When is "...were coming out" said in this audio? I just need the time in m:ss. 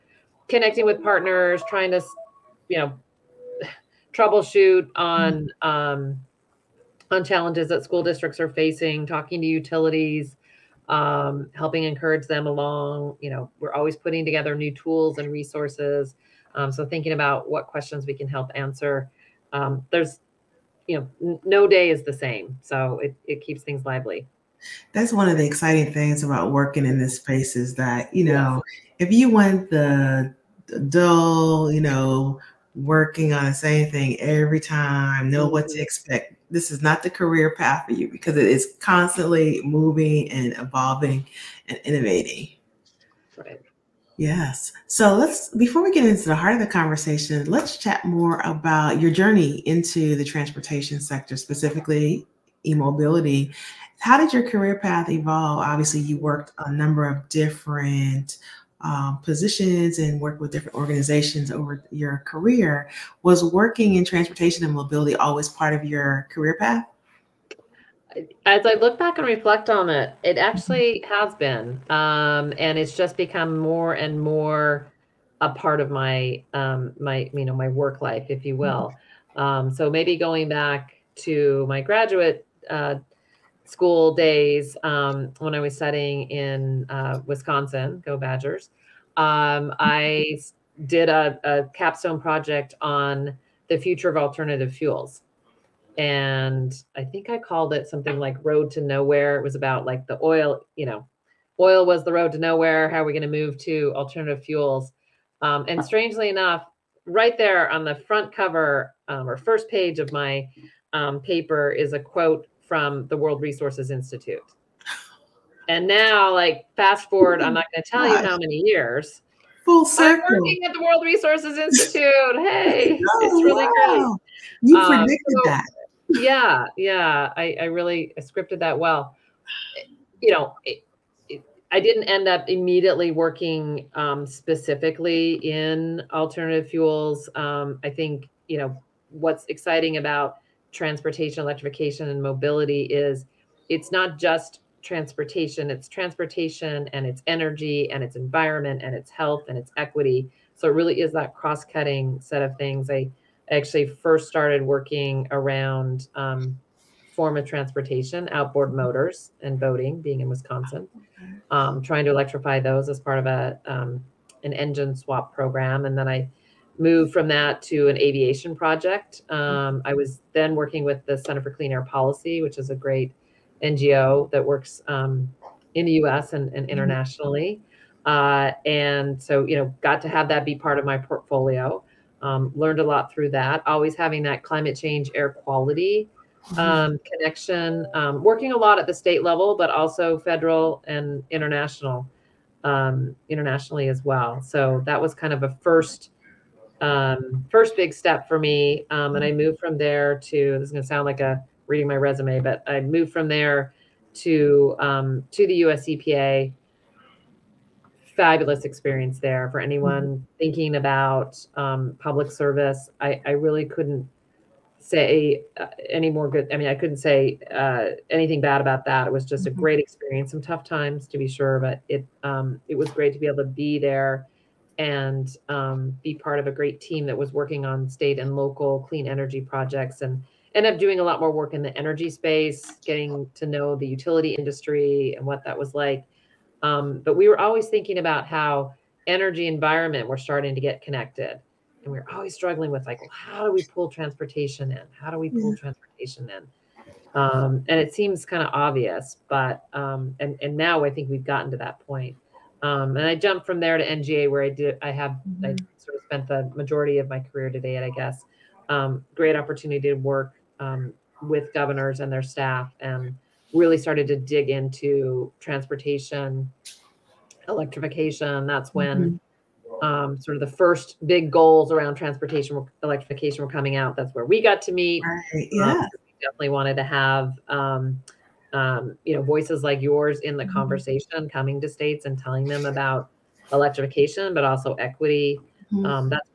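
4:33.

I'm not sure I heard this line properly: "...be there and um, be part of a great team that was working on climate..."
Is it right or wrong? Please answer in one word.
wrong.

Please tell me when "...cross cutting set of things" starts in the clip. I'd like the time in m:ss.
2:31.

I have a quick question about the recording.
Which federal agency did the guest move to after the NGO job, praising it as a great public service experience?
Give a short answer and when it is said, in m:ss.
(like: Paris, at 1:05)
US EPA, at 3:25.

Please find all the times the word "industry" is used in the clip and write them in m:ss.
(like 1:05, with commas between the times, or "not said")
3:54.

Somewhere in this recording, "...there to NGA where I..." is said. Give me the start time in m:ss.
4:13.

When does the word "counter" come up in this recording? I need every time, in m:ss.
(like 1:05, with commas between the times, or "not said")
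not said.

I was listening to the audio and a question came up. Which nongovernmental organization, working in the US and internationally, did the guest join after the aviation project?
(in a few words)
Center for Clean Air Policy.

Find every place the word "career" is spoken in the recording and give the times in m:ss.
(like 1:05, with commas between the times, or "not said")
0:37, 0:54, 1:02, 1:06, 4:17.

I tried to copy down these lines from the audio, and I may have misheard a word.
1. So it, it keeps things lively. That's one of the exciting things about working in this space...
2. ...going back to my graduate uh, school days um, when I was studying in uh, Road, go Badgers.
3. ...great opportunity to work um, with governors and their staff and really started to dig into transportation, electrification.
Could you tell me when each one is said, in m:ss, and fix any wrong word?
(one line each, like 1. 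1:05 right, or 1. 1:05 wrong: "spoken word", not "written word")
1. 0:22 right
2. 1:20 wrong: "Wisconsin", not "Road"
3. 4:19 right.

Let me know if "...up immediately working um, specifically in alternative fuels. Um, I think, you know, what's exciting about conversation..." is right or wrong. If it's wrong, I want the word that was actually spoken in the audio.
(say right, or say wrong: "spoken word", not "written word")
wrong: "transportation", not "conversation".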